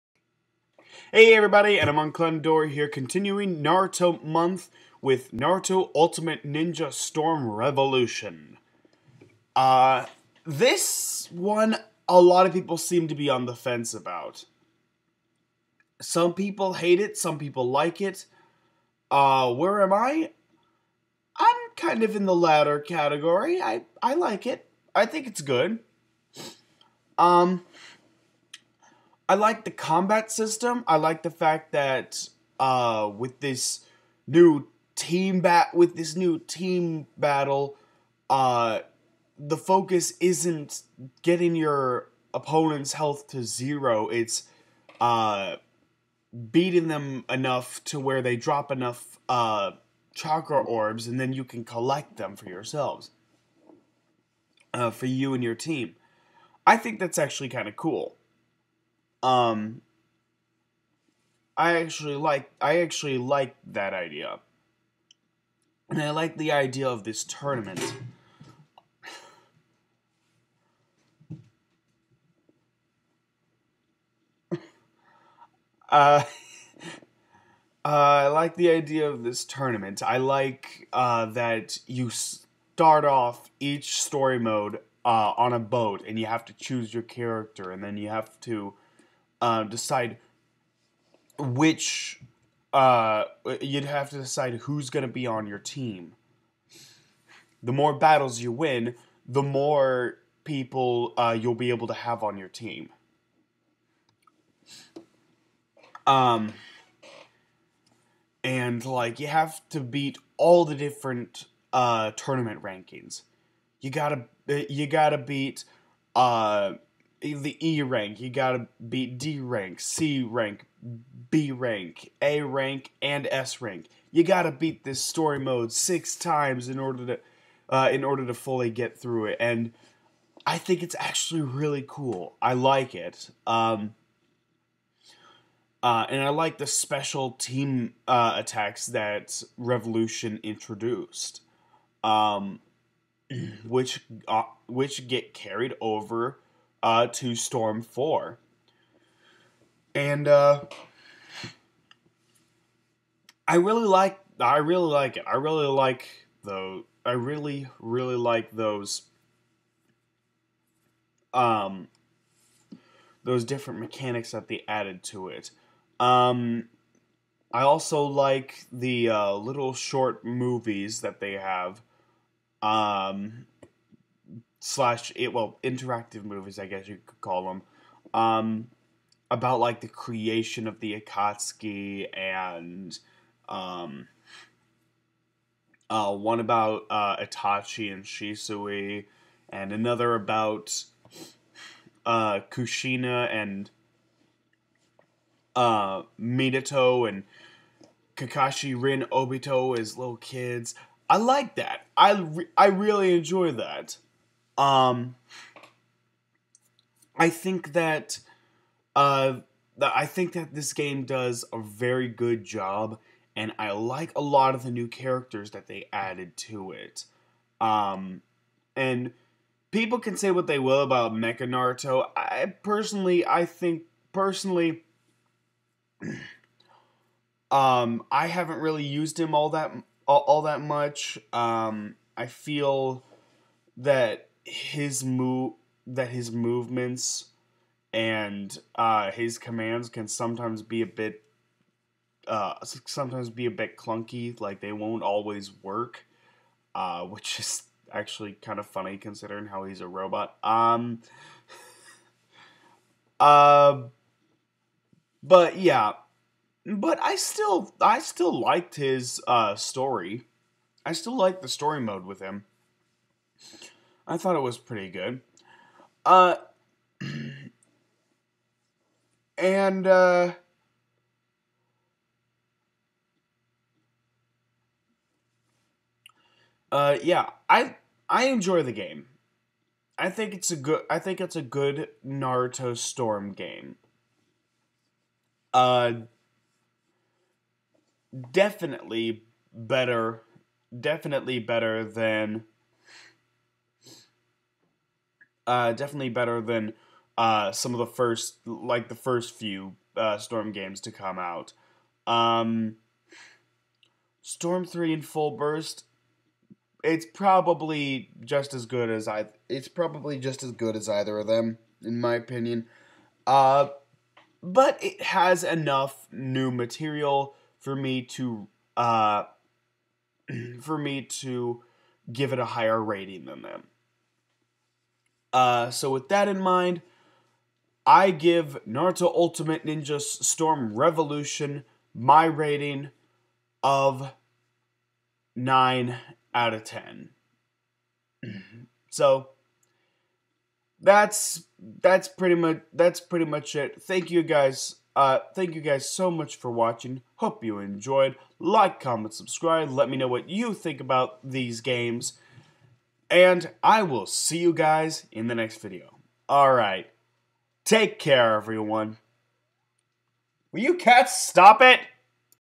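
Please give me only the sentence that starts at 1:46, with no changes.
Um, and like you have to beat all the different uh, tournament rankings.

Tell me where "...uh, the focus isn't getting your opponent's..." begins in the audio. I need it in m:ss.
0:38.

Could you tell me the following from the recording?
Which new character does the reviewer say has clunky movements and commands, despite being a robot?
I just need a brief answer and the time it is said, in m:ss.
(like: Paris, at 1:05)
Mecha Naruto, at 3:41.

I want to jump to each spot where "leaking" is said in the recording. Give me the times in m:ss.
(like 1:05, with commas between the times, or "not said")
not said.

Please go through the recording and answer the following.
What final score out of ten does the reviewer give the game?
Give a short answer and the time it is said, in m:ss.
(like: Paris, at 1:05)
9, at 5:35.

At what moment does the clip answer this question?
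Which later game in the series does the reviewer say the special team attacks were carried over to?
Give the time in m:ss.
2:27.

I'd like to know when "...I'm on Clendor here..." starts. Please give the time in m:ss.
0:01.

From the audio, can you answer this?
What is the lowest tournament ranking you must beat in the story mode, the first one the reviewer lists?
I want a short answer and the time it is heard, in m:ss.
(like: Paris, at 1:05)
E rank, at 1:57.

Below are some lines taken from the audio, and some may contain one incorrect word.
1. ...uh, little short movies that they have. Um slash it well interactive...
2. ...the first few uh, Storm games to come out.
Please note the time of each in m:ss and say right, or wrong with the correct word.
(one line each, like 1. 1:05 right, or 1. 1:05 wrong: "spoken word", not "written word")
1. 2:49 right
2. 4:58 right.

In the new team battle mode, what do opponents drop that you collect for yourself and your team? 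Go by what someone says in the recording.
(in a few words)
Chakra orbs.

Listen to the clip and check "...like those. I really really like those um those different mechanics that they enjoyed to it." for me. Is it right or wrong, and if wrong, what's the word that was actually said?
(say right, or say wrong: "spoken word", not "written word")
wrong: "added", not "enjoyed".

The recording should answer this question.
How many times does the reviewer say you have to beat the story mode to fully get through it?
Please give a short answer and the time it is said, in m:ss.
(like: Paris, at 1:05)
6, at 2:05.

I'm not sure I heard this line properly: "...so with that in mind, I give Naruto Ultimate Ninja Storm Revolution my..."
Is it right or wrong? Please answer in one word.
right.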